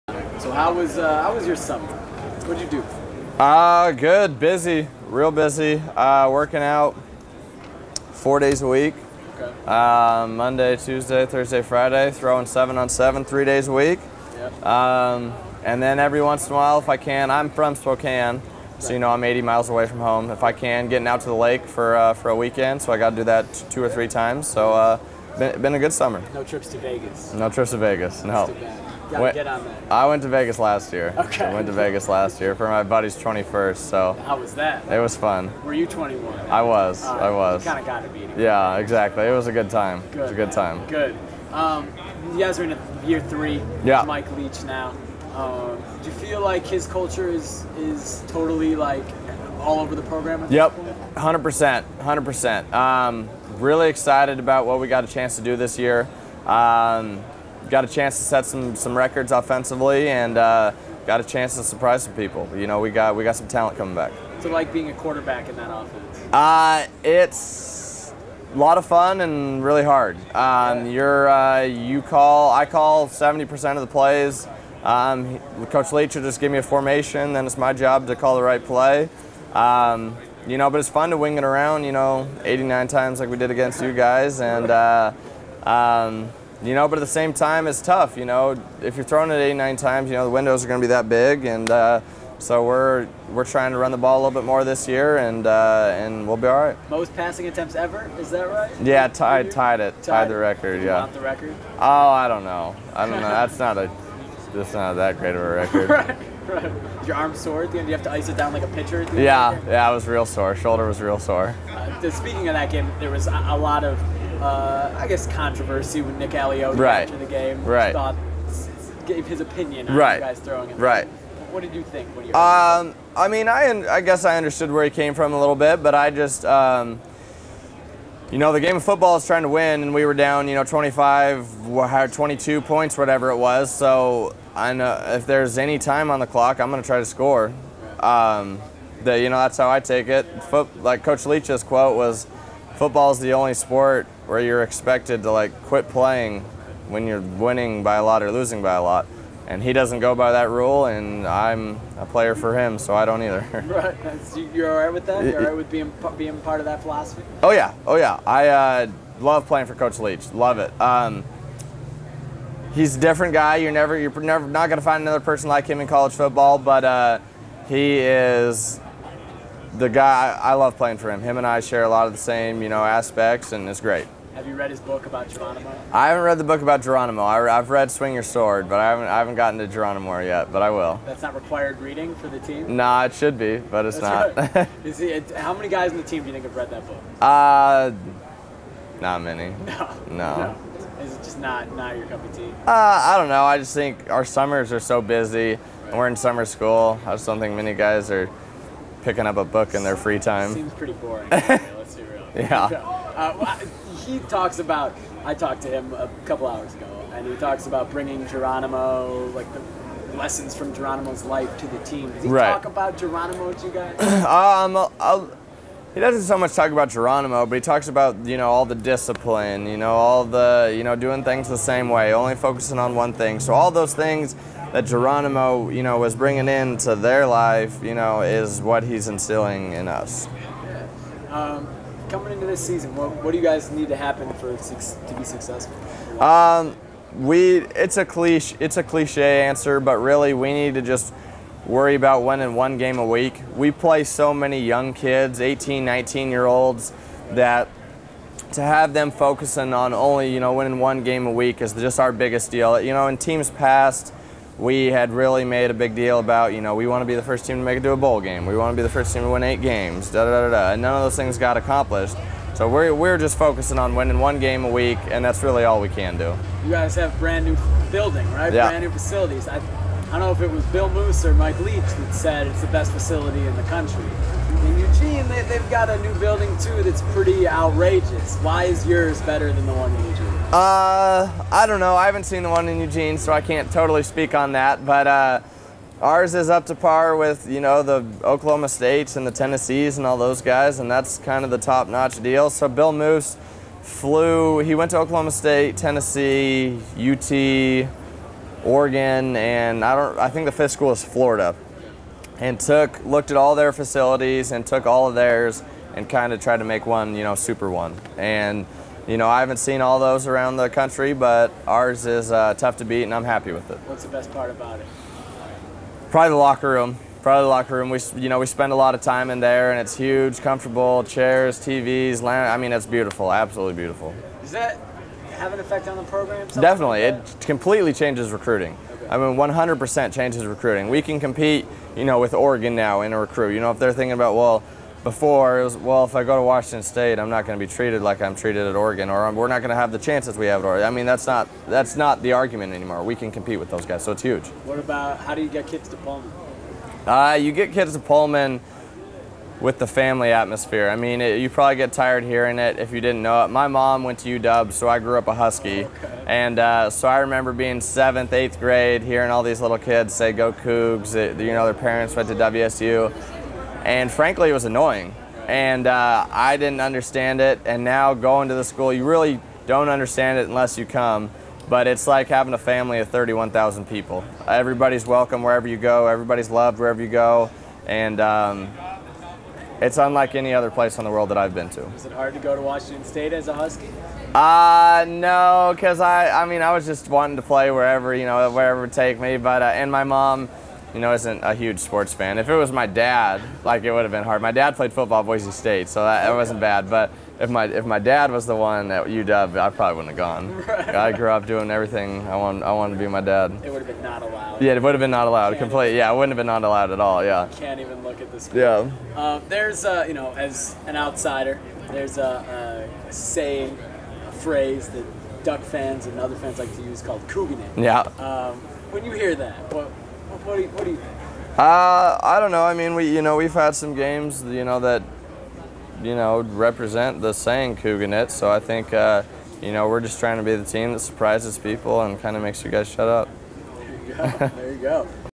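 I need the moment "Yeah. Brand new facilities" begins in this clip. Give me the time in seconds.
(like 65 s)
268 s.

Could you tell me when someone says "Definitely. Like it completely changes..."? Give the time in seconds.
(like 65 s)
326 s.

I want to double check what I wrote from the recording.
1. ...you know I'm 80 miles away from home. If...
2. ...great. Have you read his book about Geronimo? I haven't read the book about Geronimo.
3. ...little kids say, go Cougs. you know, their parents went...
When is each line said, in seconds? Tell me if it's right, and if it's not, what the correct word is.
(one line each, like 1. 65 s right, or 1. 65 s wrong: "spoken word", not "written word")
1. 18 s right
2. 173 s right
3. 359 s right.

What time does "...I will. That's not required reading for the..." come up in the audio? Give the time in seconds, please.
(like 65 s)
180 s.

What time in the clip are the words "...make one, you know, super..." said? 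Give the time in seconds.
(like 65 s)
306 s.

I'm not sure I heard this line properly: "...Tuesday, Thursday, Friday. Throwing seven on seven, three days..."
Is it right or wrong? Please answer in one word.
right.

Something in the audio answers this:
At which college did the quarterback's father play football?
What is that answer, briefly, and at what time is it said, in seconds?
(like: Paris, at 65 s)
Boise State, at 395 s.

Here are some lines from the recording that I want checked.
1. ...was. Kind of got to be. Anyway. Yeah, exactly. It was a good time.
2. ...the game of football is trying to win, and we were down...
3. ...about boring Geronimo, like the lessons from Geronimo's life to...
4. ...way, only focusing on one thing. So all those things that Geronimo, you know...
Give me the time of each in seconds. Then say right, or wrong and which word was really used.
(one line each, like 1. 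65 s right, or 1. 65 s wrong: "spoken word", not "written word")
1. 37 s right
2. 128 s right
3. 207 s wrong: "bringing", not "boring"
4. 221 s right.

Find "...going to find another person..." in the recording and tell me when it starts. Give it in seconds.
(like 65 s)
164 s.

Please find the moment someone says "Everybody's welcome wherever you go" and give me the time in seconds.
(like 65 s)
374 s.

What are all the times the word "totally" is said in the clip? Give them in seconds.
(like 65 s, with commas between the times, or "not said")
48 s, 283 s.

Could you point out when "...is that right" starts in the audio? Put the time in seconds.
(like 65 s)
98 s.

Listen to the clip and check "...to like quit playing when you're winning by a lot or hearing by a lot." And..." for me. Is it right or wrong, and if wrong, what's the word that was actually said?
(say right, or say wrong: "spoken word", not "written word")
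wrong: "losing", not "hearing".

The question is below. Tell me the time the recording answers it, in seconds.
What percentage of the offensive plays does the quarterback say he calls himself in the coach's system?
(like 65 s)
73 s.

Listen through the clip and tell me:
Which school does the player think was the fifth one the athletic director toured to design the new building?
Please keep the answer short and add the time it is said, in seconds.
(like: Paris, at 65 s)
Florida, at 301 s.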